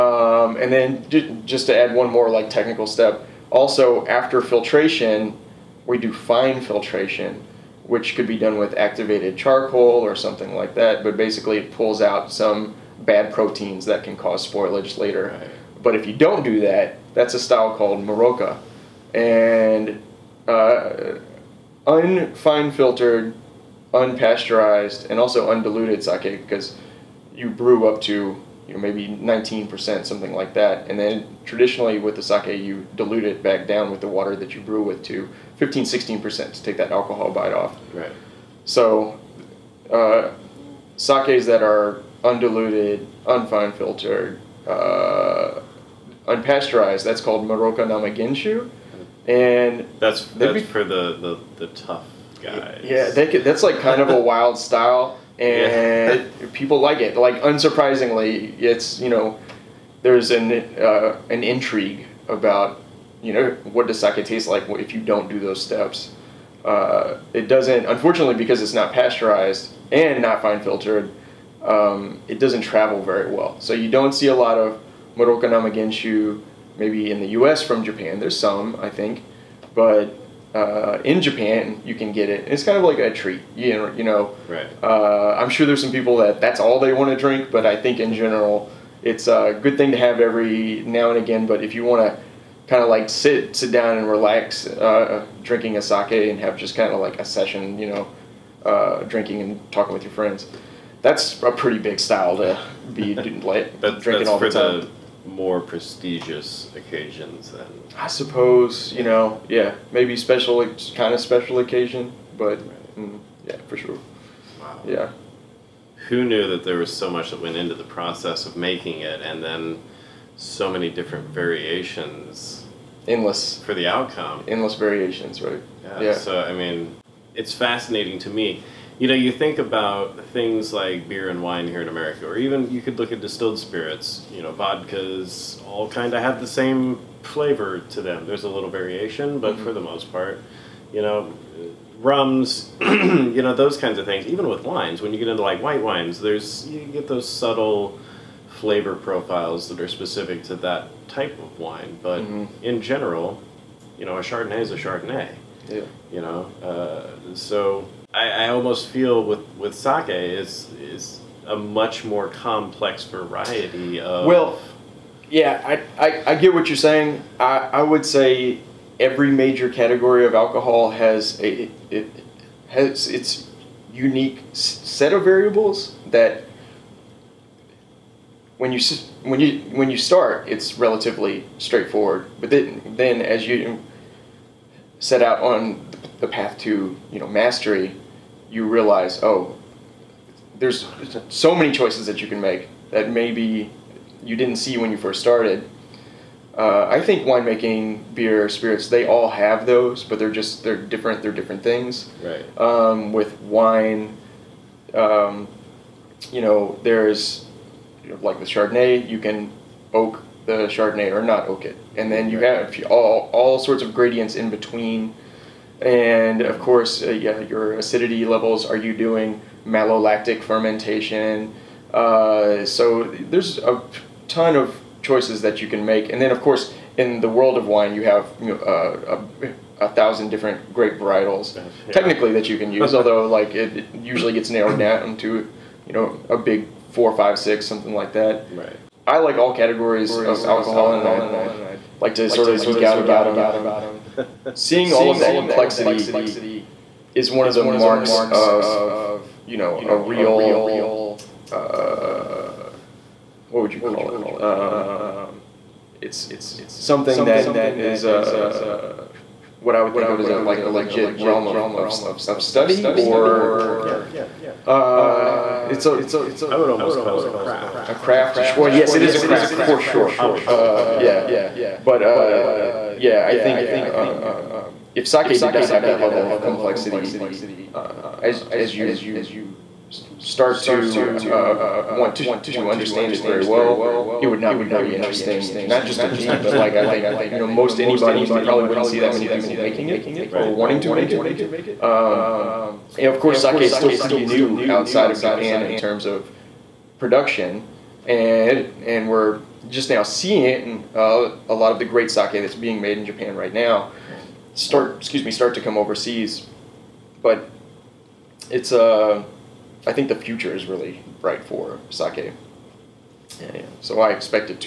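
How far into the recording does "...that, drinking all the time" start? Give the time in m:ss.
1:43.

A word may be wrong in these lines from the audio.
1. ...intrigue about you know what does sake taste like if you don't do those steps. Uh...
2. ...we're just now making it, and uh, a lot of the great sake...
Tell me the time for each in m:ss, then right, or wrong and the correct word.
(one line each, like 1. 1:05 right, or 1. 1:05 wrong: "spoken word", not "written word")
1. 1:01 right
2. 4:59 wrong: "seeing", not "making".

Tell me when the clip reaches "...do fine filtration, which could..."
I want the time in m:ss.
0:05.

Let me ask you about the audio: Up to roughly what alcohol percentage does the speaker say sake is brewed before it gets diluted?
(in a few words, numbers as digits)
19%.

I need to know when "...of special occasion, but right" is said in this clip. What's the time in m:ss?
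1:51.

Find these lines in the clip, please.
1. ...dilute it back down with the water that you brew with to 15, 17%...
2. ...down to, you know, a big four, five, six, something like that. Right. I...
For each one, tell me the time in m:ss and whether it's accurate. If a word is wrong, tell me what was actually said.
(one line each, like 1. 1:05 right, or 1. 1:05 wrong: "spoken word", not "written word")
1. 0:32 wrong: "16", not "17"
2. 3:54 right.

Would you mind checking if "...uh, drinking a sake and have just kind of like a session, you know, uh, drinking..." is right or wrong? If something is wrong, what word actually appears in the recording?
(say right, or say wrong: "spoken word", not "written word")
right.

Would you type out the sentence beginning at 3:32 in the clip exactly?
have all all sorts of gradients in between and of course, uh, yeah, your acidity levels.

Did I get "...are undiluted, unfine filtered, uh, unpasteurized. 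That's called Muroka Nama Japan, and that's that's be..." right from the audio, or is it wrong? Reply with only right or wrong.
wrong.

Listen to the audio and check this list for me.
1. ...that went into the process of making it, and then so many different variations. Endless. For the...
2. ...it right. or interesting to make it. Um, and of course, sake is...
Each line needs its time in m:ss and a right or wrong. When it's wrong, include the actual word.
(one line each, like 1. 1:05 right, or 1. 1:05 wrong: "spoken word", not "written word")
1. 1:57 right
2. 4:49 wrong: "wanting", not "interesting".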